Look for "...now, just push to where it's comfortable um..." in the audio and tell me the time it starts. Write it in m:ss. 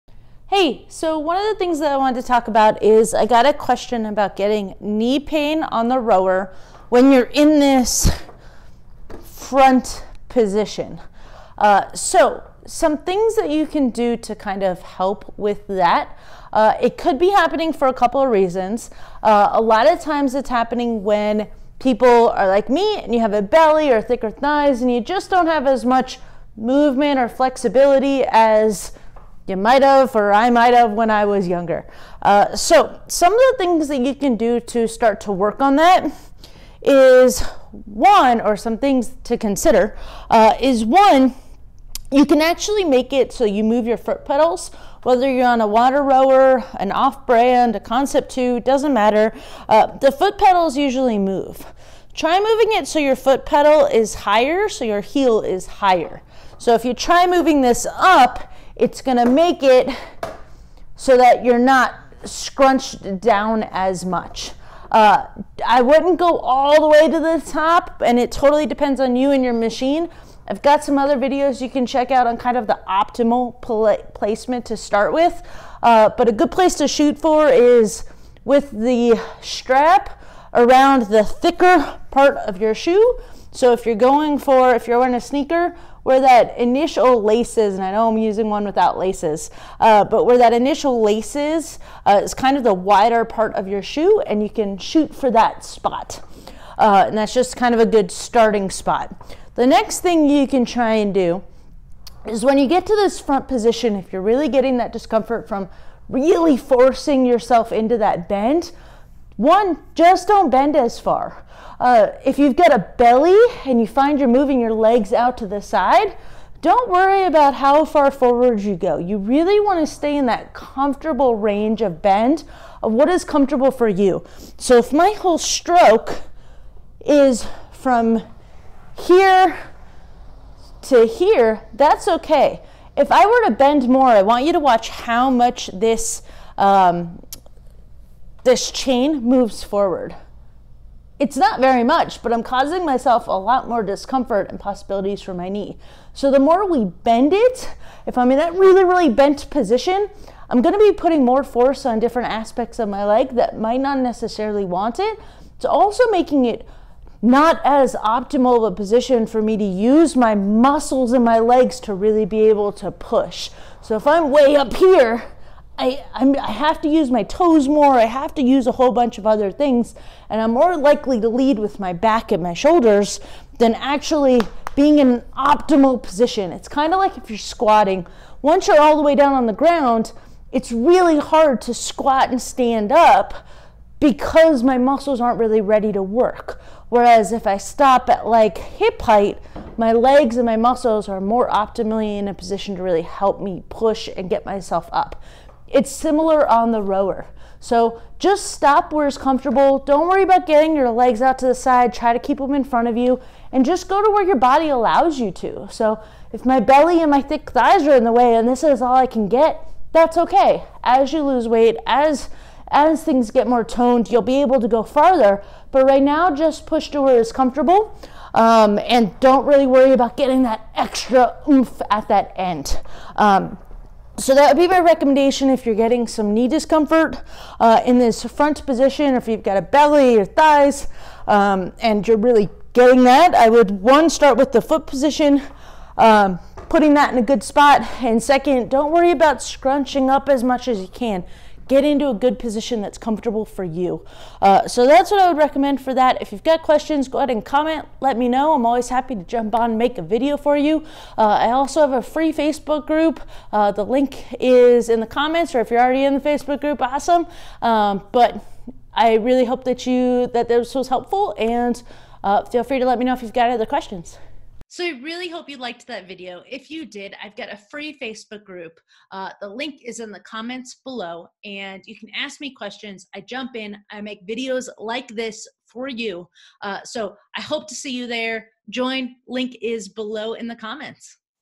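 3:36.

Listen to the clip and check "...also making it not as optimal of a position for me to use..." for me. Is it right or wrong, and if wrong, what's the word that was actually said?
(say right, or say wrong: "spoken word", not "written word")
right.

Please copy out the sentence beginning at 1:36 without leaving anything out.
Uh, and that's just kind of a good starting spot.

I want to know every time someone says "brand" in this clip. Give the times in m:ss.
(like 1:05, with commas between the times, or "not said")
0:47.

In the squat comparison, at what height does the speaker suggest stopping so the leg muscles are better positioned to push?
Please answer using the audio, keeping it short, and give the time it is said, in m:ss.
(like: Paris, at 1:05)
hip height, at 3:08.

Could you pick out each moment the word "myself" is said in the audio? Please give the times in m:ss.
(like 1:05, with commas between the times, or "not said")
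2:22, 3:14.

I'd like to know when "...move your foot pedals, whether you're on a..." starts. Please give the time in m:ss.
0:43.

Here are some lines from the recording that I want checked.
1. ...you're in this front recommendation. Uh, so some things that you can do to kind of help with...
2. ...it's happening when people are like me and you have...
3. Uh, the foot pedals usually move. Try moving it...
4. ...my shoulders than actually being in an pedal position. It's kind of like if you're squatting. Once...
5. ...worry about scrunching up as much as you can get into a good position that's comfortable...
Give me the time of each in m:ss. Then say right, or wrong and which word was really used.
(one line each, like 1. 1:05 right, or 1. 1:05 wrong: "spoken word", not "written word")
1. 0:07 wrong: "position", not "recommendation"
2. 0:20 right
3. 0:49 right
4. 2:52 wrong: "optimal", not "pedal"
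5. 3:58 right.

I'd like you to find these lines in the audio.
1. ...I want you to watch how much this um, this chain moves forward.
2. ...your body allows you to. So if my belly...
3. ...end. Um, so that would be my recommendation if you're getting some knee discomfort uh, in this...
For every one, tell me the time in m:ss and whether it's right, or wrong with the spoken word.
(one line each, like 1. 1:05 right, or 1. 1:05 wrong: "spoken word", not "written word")
1. 2:14 right
2. 3:24 right
3. 3:42 right.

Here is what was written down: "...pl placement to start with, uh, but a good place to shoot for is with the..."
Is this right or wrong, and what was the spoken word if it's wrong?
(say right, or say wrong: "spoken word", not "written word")
right.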